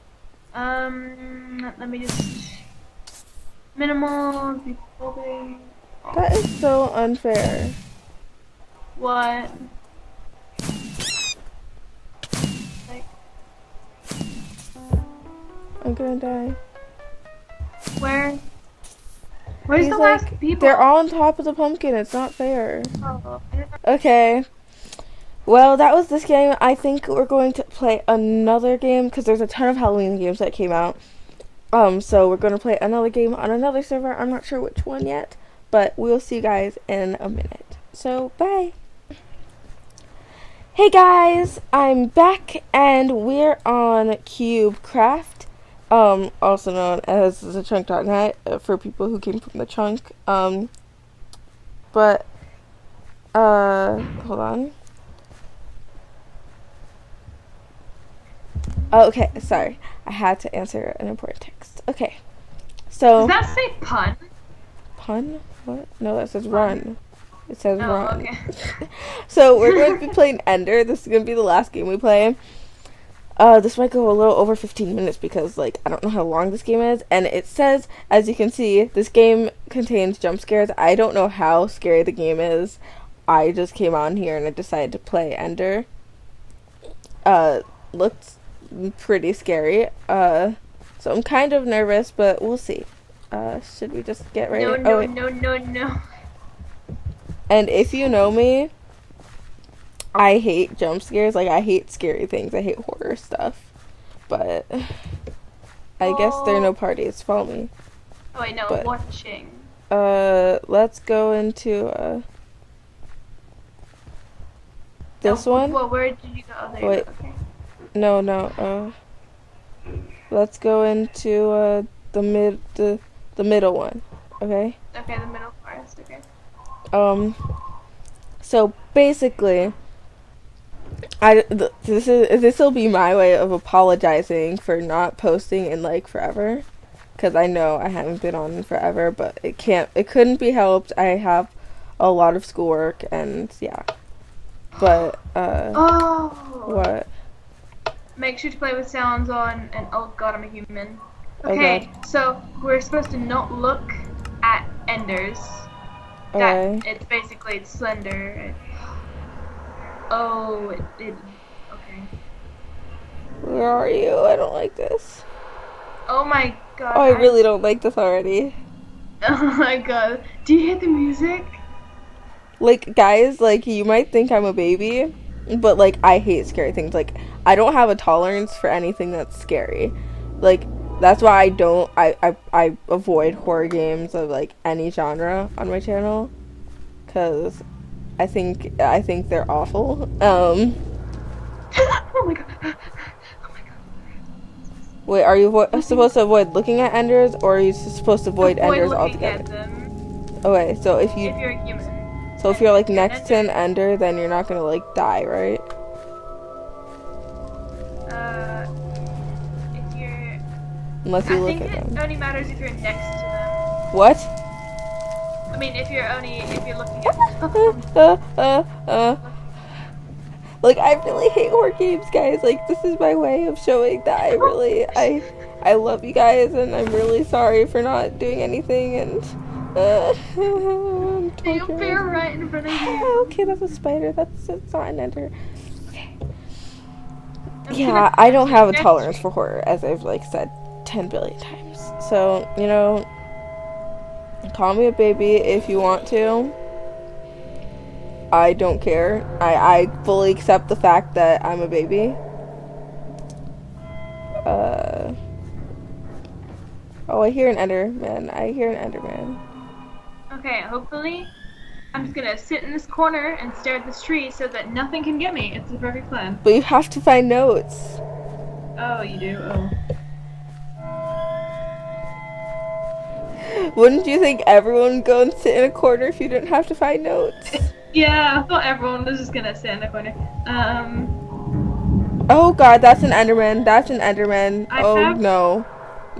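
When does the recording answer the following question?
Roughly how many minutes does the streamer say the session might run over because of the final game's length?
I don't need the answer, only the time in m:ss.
1:14.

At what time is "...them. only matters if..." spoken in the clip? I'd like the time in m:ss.
3:31.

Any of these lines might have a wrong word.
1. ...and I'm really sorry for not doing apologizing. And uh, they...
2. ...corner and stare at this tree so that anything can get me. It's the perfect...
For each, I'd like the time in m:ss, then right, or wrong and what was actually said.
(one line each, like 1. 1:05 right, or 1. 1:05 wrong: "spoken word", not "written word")
1. 3:46 wrong: "anything", not "apologizing"
2. 4:22 wrong: "nothing", not "anything".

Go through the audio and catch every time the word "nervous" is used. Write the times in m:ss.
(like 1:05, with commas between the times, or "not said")
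1:31.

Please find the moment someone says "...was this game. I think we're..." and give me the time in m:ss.
0:25.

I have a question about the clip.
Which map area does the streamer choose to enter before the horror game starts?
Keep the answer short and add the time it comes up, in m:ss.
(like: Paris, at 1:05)
the middle forest, at 2:05.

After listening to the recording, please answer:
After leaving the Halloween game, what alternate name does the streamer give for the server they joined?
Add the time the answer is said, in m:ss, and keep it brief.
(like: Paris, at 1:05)
the chunk.net, at 0:47.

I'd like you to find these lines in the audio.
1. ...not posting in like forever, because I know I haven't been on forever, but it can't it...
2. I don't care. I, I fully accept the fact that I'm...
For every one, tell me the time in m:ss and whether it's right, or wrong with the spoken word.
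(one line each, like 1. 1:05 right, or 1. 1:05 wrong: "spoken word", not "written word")
1. 2:14 right
2. 4:08 right.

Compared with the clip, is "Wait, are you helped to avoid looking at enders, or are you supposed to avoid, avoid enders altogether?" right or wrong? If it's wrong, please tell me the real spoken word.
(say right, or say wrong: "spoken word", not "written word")
wrong: "supposed", not "helped".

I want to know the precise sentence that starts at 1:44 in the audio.
But I guess there are no parties.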